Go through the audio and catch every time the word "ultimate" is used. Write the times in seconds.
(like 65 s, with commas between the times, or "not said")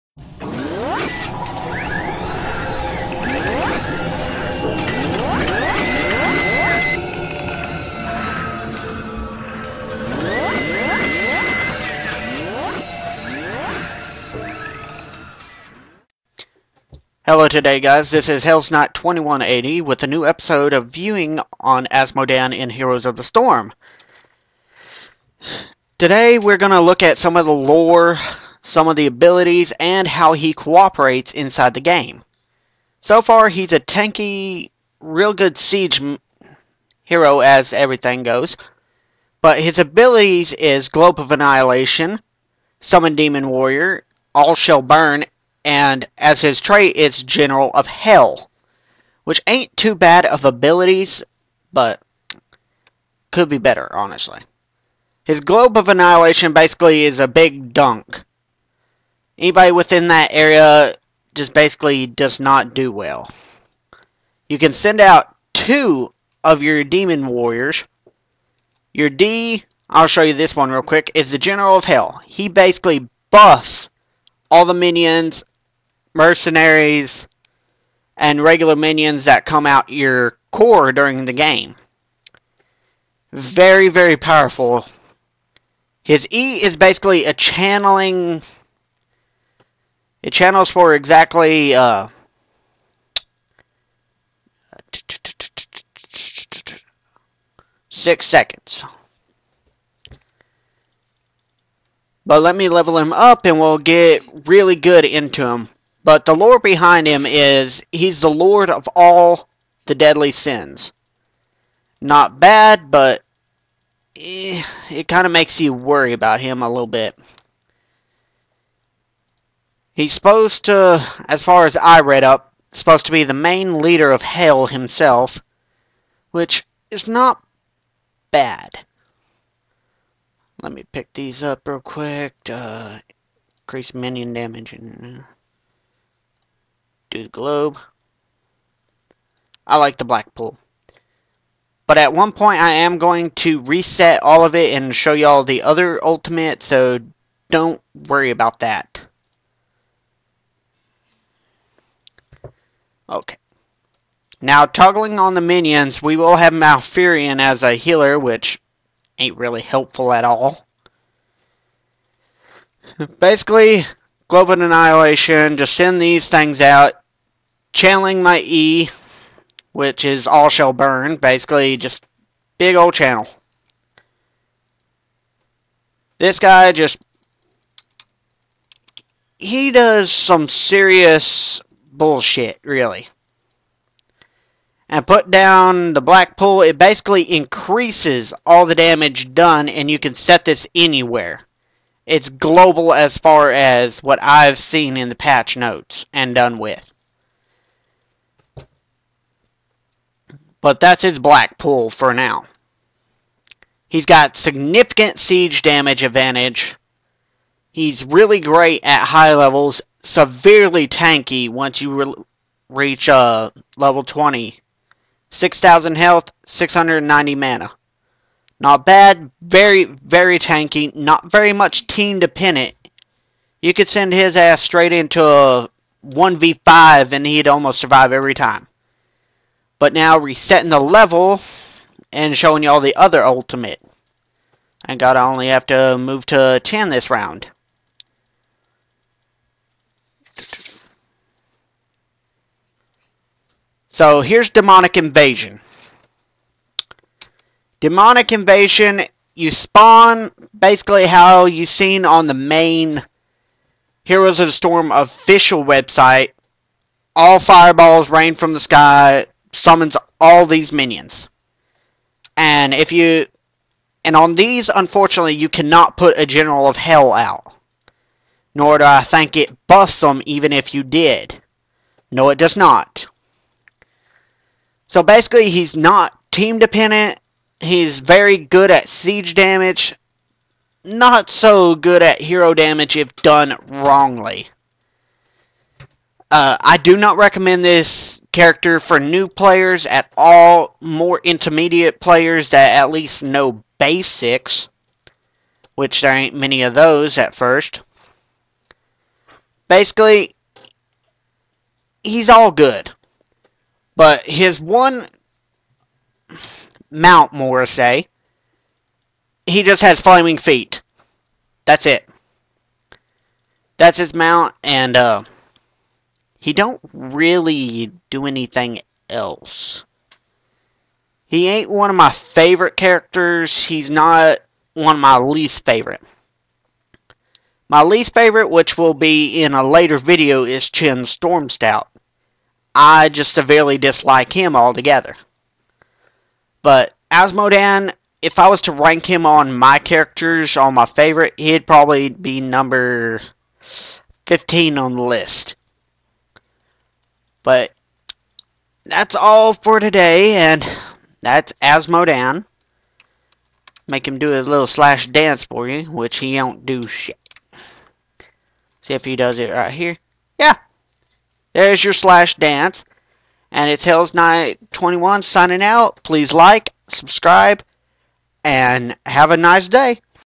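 146 s, 233 s.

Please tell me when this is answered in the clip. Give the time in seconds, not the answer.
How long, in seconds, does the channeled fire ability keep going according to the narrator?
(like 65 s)
97 s.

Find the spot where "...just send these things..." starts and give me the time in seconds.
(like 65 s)
165 s.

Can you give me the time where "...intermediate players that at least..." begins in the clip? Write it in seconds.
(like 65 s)
291 s.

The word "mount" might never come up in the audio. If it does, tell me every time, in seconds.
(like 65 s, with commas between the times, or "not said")
306 s, 314 s.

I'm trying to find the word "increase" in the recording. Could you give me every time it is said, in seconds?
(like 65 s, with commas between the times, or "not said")
133 s, 187 s.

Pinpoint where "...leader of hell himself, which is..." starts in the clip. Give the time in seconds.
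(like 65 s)
123 s.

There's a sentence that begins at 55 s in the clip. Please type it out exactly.
His Globe of Annihilation basically is a big dunk.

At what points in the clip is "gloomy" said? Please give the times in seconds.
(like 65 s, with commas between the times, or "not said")
not said.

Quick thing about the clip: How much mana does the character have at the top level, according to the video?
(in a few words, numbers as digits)
690.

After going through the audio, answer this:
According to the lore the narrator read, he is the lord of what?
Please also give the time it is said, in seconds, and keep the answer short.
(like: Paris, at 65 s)
all the deadly sins, at 108 s.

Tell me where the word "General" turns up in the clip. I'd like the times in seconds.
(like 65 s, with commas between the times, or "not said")
47 s, 71 s, 266 s.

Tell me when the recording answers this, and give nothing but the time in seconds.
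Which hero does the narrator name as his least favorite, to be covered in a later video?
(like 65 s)
330 s.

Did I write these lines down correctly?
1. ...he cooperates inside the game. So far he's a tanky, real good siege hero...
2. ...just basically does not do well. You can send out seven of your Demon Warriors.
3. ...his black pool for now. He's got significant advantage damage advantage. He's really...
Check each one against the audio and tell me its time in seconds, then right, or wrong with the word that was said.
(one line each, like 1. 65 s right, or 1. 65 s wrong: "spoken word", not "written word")
1. 30 s right
2. 61 s wrong: "two", not "seven"
3. 201 s wrong: "siege", not "advantage".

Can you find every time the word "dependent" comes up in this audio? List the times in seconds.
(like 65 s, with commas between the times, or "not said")
222 s, 276 s.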